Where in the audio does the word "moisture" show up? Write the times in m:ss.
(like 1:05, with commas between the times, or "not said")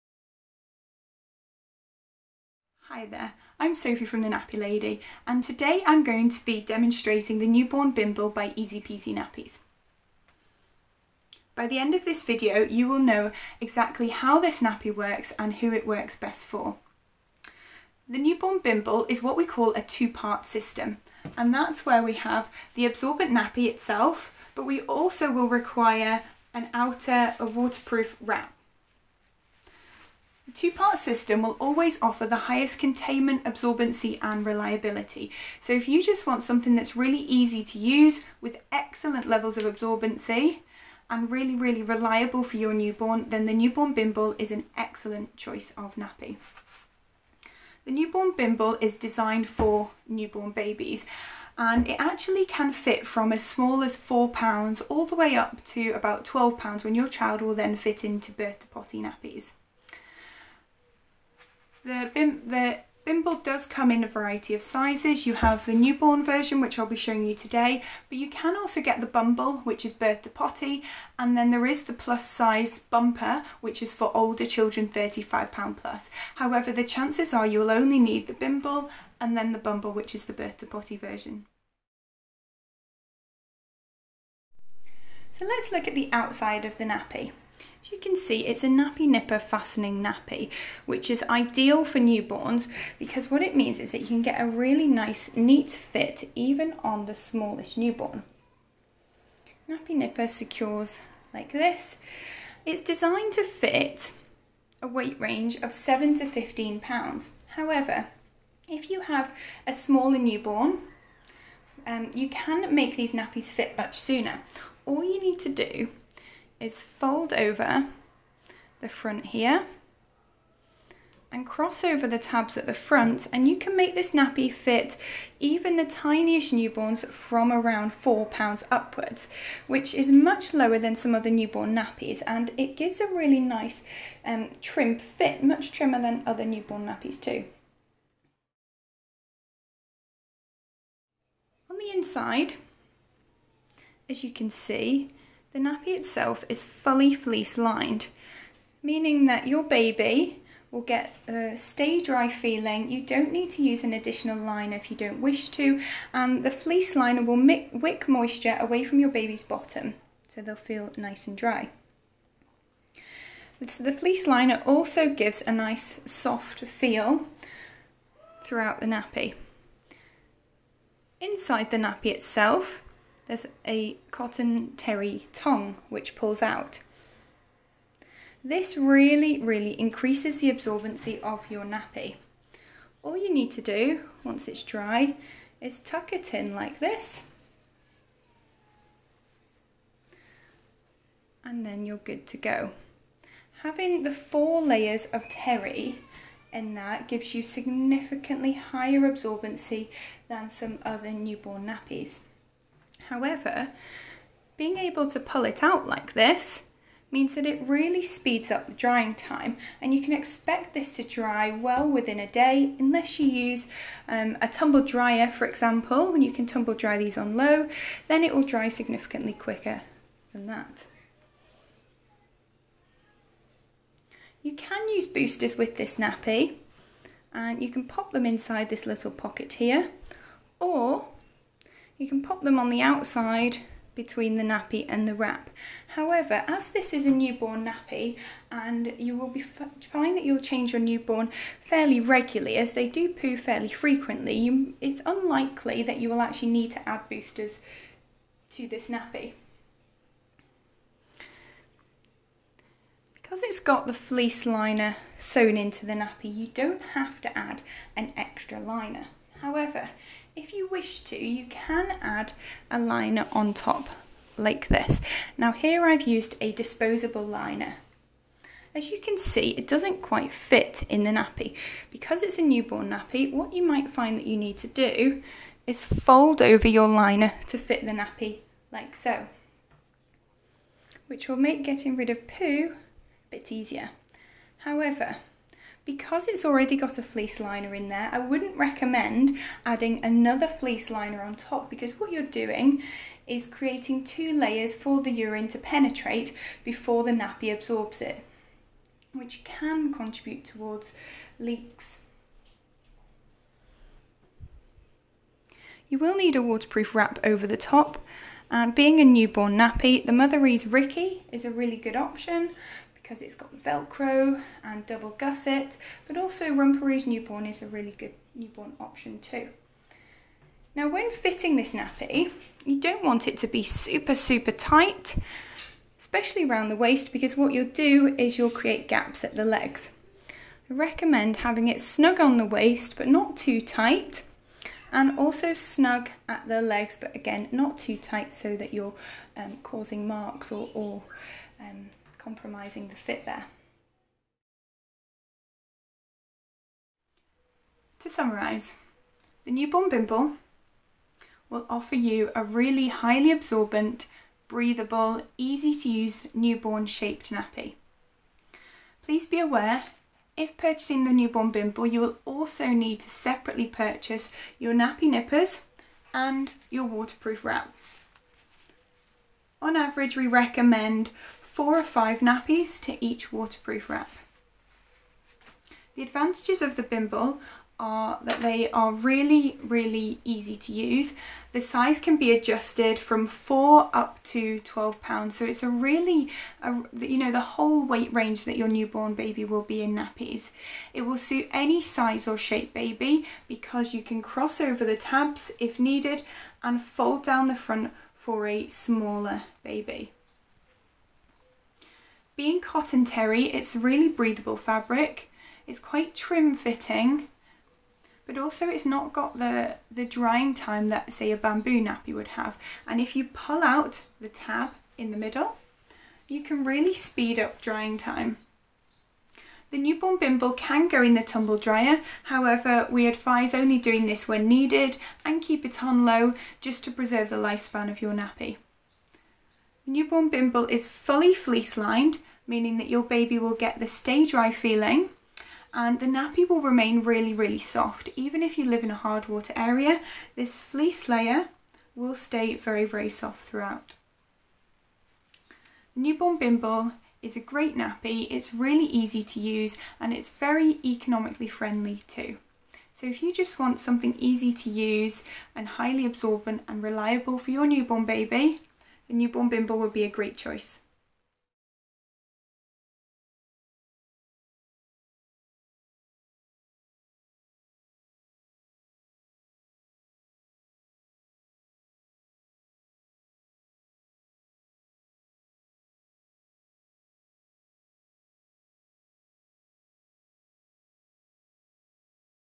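2:38.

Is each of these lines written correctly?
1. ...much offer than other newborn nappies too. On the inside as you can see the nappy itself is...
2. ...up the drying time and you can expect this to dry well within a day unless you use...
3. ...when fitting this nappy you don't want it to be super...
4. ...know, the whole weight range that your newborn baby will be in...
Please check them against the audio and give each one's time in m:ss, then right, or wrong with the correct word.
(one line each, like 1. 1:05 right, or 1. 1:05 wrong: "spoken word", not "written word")
1. 2:15 wrong: "trimmer", not "offer"
2. 3:28 right
3. 5:20 right
4. 6:27 right.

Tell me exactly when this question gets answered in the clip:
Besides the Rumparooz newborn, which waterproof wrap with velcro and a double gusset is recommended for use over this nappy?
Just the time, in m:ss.
5:10.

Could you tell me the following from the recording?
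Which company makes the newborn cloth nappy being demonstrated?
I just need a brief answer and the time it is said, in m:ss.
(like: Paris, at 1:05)
Easy Peasy Nappies, at 0:08.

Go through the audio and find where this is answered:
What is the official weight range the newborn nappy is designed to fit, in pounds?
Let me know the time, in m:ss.
1:45.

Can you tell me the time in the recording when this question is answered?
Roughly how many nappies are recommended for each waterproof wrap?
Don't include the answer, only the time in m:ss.
6:11.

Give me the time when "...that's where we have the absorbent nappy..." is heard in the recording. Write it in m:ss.
0:21.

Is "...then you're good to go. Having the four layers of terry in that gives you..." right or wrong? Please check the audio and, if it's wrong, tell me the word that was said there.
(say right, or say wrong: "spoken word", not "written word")
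right.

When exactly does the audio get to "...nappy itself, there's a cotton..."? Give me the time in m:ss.
2:51.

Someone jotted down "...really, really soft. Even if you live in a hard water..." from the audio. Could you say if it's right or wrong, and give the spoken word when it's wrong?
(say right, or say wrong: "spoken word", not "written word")
right.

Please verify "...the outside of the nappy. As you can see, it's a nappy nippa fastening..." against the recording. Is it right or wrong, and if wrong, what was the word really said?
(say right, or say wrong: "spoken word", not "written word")
right.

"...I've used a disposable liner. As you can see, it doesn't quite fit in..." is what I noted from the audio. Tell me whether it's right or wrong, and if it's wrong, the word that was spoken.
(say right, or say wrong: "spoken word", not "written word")
right.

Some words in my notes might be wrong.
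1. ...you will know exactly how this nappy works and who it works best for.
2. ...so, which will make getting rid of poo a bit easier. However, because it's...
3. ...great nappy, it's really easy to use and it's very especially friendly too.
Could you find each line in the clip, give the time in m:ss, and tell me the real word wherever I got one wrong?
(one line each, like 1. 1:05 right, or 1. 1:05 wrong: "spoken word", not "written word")
1. 0:12 right
2. 4:38 right
3. 7:27 wrong: "economically", not "especially".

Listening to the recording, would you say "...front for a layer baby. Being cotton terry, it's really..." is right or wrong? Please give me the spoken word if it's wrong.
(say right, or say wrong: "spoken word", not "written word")
wrong: "smaller", not "layer".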